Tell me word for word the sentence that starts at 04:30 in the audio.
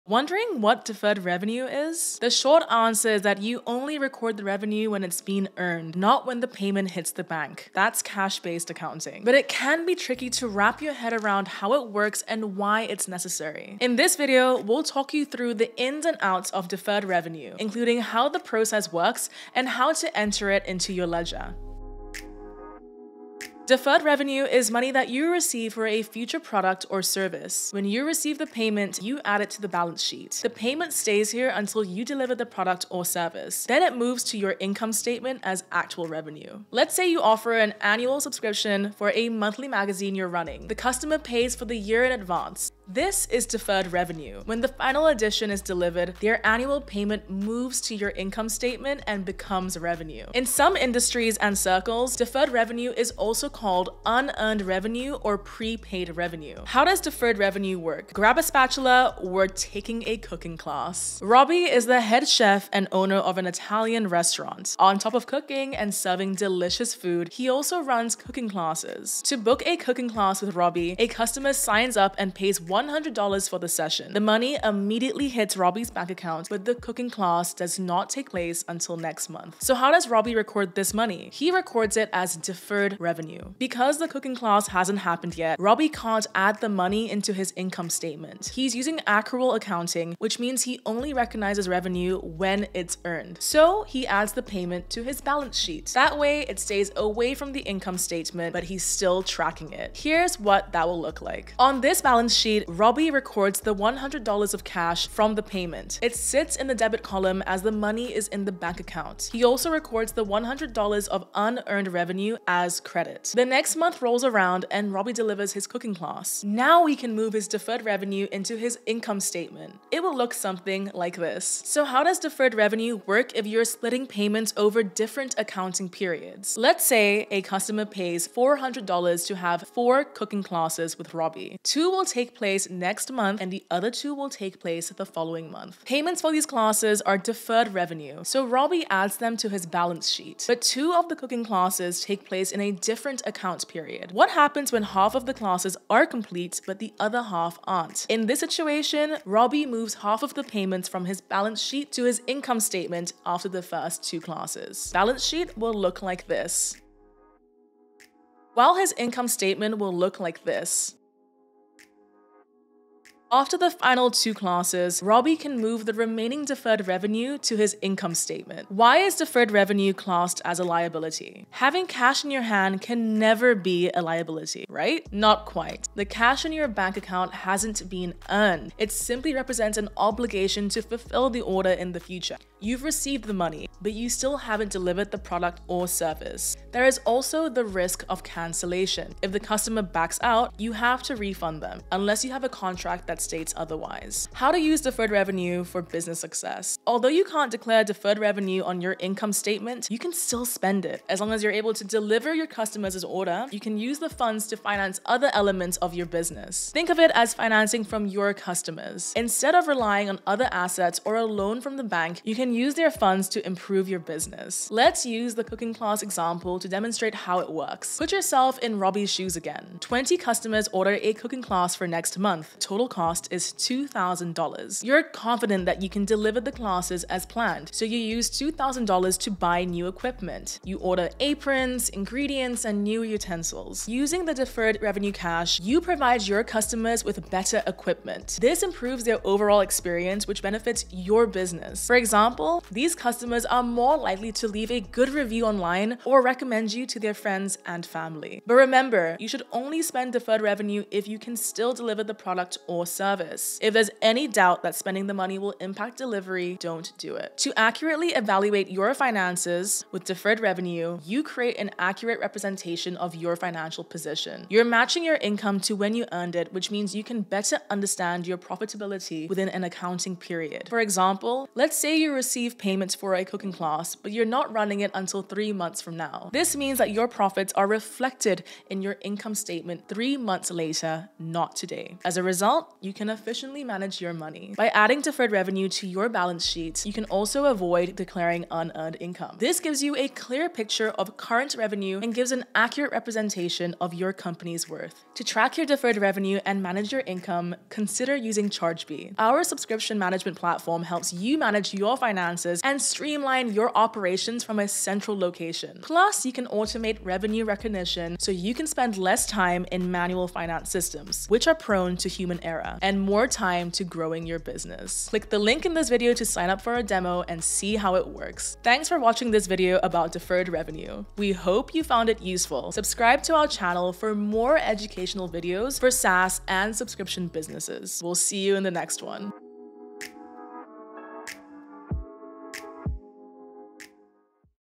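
For example, let's say you receive receive payments for a cooking class, but you're not running it until three months from now.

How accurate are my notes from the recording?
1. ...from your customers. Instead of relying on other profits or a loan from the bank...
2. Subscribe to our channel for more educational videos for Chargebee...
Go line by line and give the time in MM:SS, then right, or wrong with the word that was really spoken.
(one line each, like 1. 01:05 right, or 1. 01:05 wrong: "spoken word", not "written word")
1. 03:27 wrong: "assets", not "profits"
2. 05:22 wrong: "SaaS", not "Chargebee".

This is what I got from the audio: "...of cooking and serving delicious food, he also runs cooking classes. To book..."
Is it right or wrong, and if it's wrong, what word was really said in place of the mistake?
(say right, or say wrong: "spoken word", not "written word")
right.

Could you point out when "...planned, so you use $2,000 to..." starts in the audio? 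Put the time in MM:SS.
03:47.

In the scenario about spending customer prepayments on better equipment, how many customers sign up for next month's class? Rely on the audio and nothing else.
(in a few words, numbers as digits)
20.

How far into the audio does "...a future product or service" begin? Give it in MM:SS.
00:25.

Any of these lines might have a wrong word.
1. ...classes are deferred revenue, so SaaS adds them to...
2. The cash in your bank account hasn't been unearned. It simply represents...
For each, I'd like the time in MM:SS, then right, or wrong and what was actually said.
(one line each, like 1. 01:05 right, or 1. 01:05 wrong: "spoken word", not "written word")
1. 02:16 wrong: "Robbie", not "SaaS"
2. 02:55 wrong: "earned", not "unearned".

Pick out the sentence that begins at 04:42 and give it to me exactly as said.
As a result, you can efficiently manage your money.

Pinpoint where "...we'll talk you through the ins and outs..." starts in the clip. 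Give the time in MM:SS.
00:14.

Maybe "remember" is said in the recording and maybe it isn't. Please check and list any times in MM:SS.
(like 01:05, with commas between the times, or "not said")
04:08.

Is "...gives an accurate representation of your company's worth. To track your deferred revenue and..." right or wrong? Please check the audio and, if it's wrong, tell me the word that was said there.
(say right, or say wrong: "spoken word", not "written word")
right.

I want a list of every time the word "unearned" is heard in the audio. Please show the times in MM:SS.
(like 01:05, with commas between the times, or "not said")
00:54, 01:51, 04:48.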